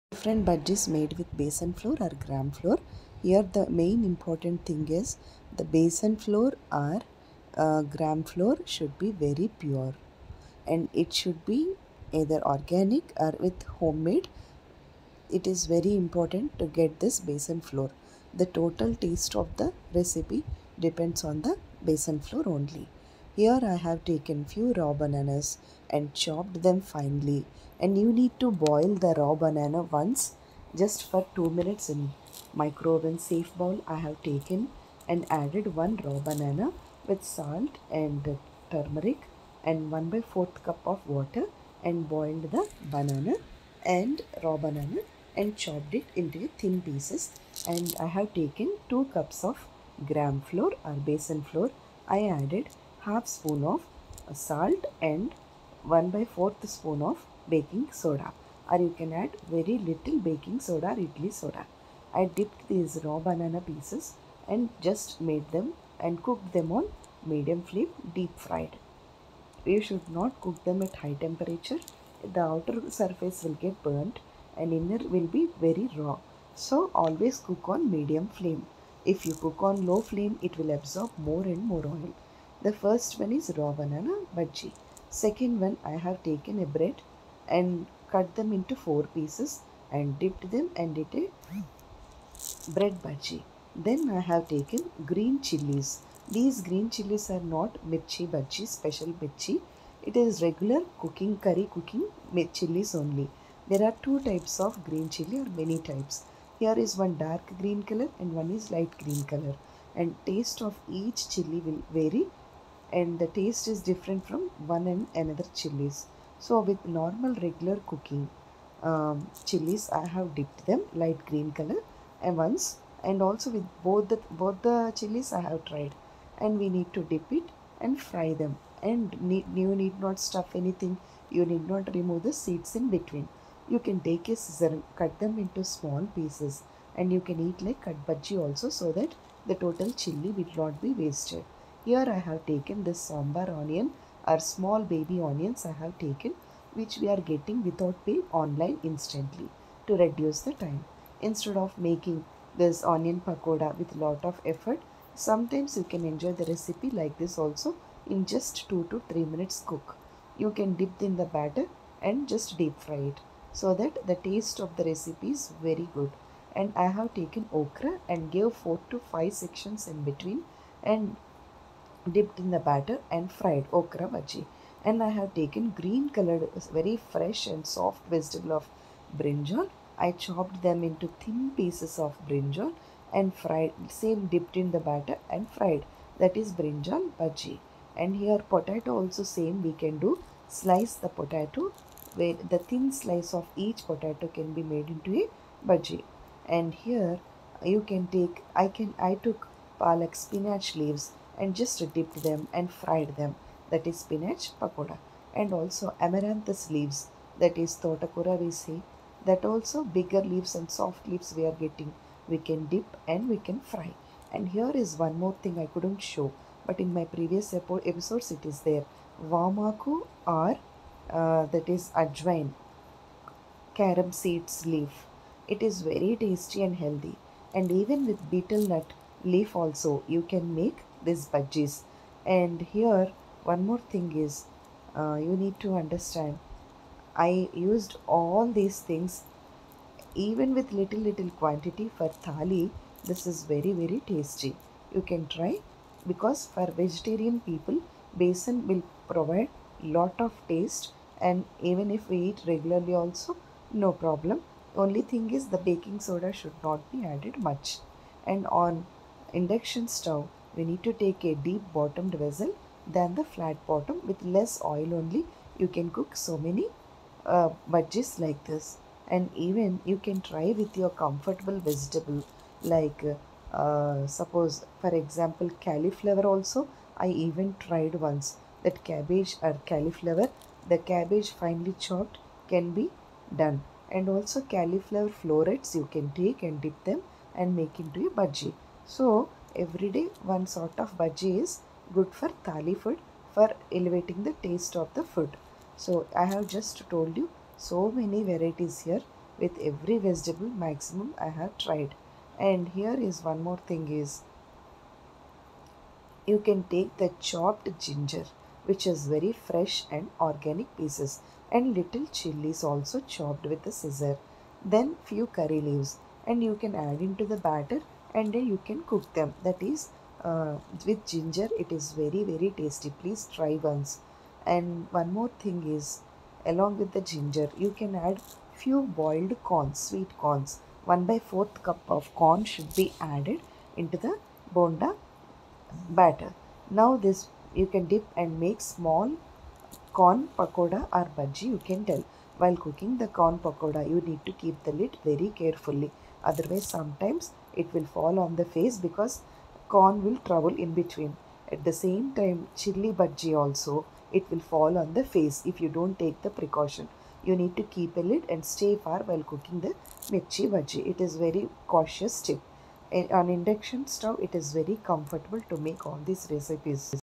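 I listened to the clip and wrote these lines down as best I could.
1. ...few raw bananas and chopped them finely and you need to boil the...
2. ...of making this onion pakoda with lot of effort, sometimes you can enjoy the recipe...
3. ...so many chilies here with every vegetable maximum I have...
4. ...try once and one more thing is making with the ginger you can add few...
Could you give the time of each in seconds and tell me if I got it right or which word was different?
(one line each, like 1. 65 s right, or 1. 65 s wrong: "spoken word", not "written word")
1. 24 s right
2. 151 s right
3. 297 s wrong: "varieties", not "chilies"
4. 323 s wrong: "along", not "making".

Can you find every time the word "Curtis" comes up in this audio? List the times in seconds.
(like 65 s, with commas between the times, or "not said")
not said.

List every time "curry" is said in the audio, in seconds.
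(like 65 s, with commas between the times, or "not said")
101 s, 315 s.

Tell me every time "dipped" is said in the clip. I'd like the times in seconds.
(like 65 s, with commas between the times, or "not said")
62 s, 90 s, 120 s, 172 s, 184 s, 201 s.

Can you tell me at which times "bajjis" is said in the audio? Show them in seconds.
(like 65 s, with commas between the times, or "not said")
0 s, 231 s, 267 s, 288 s.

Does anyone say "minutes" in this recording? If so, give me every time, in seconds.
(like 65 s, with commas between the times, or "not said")
31 s, 159 s.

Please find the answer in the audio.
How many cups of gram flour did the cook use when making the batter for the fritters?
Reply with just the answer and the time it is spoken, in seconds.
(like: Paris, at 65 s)
2 cups, at 48 s.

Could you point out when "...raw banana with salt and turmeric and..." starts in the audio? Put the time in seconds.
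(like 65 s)
36 s.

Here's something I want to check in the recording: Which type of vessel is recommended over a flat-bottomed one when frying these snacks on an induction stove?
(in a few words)
Deep bottomed vessel.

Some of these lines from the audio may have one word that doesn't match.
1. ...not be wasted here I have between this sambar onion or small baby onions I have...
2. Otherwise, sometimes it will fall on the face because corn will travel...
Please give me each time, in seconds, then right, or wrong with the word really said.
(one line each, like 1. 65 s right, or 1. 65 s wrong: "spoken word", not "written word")
1. 140 s wrong: "taken", not "between"
2. 346 s right.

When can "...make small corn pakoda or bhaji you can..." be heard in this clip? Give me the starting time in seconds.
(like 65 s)
338 s.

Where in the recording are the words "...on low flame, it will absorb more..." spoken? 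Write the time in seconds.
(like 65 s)
79 s.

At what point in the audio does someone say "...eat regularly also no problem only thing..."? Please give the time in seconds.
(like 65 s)
252 s.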